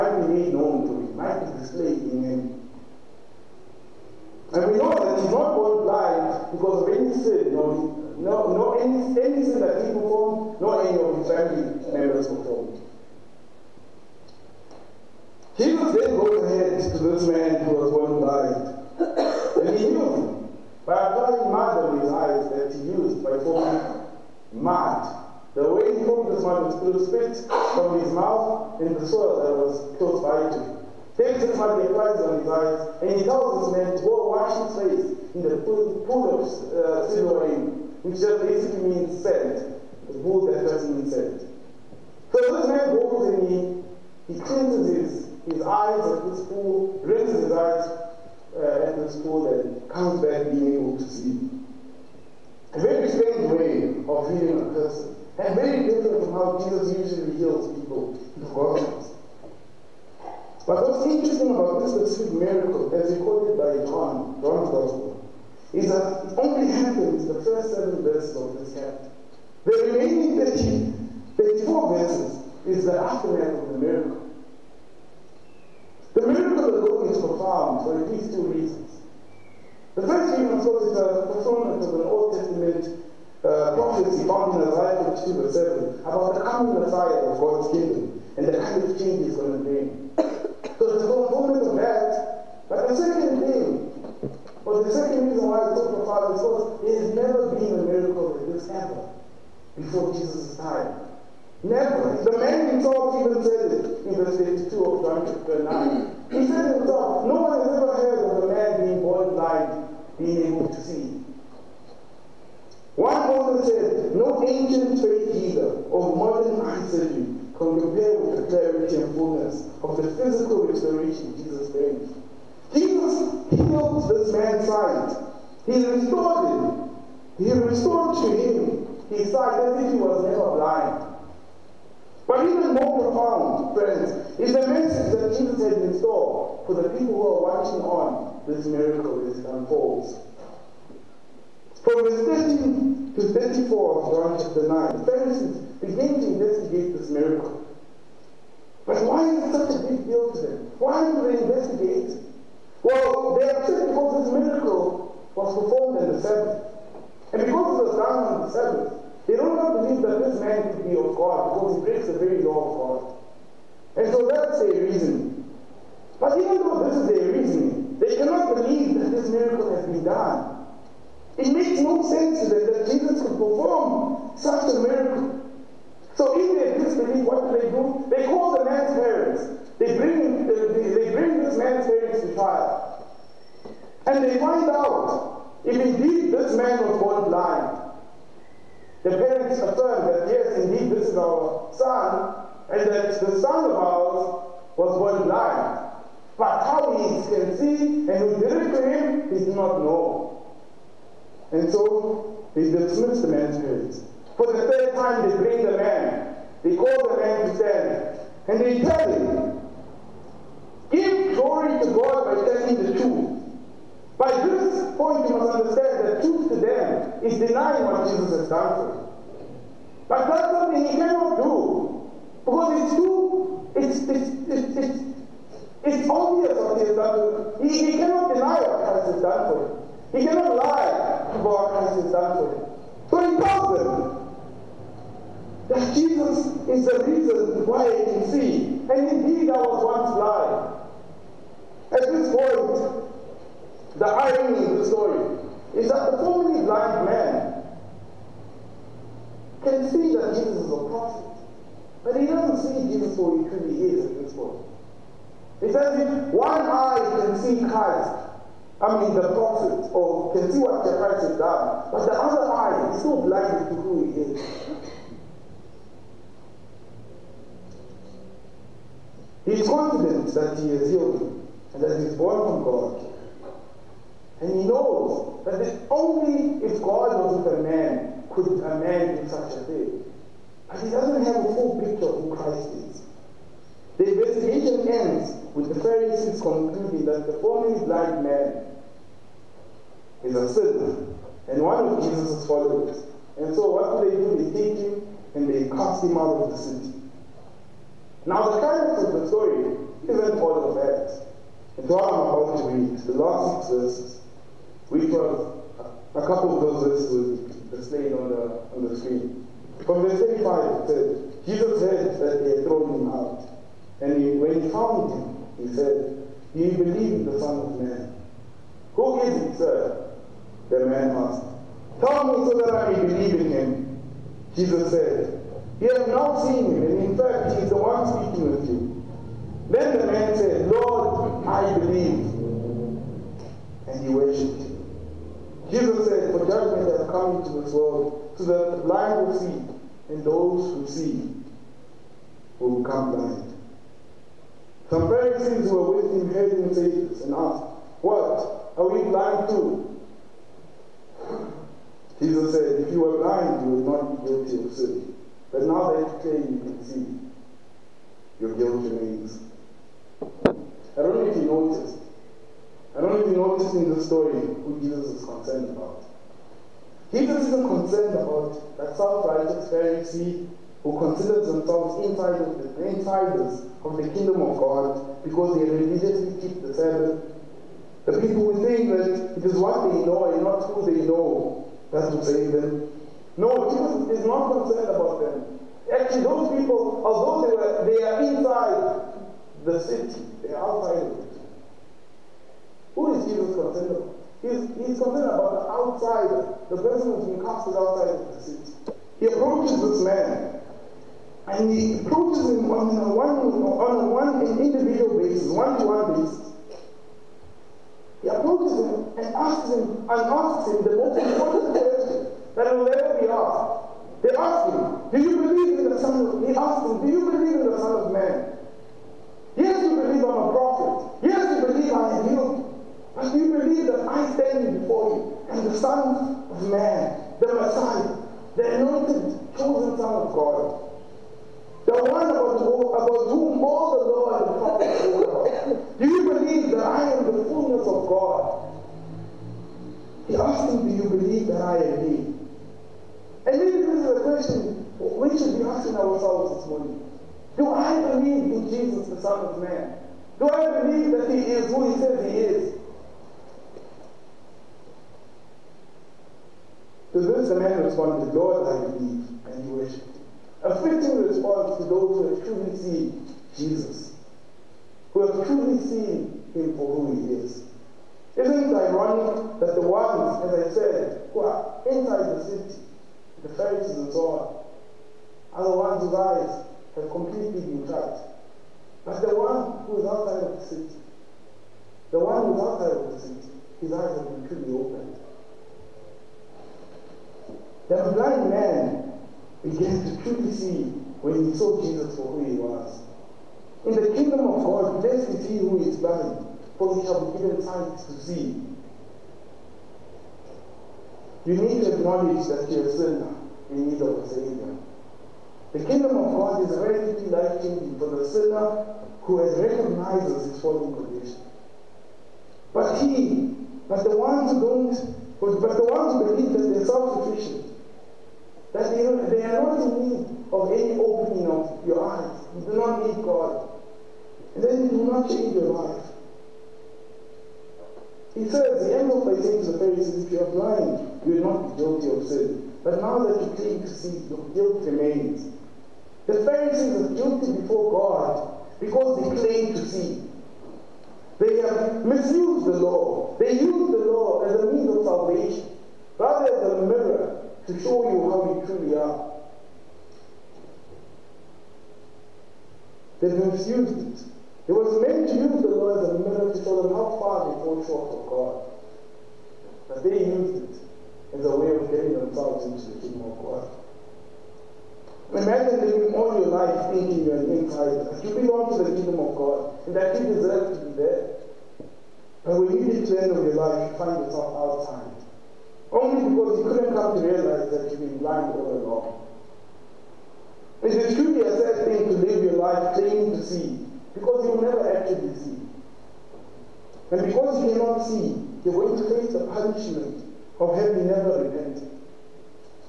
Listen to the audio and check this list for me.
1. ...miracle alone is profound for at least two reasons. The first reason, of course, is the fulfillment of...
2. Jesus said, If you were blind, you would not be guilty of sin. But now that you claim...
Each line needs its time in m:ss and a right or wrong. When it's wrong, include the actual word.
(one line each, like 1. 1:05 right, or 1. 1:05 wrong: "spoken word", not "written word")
1. 1:16 right
2. 5:52 right.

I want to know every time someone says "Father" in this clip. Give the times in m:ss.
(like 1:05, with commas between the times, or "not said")
1:36.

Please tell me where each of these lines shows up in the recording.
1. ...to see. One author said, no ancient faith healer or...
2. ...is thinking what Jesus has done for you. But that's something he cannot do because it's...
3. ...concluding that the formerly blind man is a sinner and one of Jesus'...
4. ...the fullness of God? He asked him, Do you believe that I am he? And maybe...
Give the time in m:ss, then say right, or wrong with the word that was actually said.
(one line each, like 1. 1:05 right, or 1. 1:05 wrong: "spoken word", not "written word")
1. 1:50 right
2. 3:37 wrong: "denying", not "thinking"
3. 4:46 right
4. 7:17 right.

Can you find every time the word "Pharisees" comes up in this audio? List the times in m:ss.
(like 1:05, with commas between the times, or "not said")
2:25, 4:45, 5:45, 6:09, 7:53, 8:49, 8:56.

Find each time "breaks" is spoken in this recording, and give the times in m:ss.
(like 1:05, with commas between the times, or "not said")
2:41.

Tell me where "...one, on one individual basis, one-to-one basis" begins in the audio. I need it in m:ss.
6:43.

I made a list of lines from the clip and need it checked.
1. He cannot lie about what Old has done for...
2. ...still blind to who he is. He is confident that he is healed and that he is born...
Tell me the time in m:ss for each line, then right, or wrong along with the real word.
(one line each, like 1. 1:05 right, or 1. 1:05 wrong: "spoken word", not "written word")
1. 3:50 wrong: "Christ", not "Old"
2. 4:23 right.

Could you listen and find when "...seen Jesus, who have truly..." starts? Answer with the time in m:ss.
7:42.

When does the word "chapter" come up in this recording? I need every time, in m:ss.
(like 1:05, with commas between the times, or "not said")
1:08, 1:45, 2:24.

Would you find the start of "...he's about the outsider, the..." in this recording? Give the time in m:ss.
6:34.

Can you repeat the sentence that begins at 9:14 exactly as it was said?
It was meant to use the law as a mirror to show them how far they fall short of God.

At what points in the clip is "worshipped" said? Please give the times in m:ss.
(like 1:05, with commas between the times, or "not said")
5:34, 7:39.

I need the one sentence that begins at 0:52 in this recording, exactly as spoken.
A very strange way of healing a person, and very different from how Jesus usually heals people in the world.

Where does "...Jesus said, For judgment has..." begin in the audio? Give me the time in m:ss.
5:35.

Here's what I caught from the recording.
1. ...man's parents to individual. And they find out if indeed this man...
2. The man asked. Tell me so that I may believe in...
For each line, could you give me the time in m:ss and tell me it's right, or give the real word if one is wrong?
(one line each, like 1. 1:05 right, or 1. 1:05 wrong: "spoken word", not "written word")
1. 3:01 wrong: "trial", not "individual"
2. 5:20 right.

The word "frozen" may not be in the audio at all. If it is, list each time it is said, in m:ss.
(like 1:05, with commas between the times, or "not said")
not said.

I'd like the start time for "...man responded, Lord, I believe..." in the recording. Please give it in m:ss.
7:37.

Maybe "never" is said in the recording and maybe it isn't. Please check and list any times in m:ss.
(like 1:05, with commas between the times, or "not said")
1:37, 1:41, 2:10, 9:44, 9:51.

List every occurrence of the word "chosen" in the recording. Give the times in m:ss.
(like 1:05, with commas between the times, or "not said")
7:09.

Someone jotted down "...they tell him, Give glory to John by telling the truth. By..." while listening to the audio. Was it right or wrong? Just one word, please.
wrong.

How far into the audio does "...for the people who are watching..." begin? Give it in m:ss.
2:16.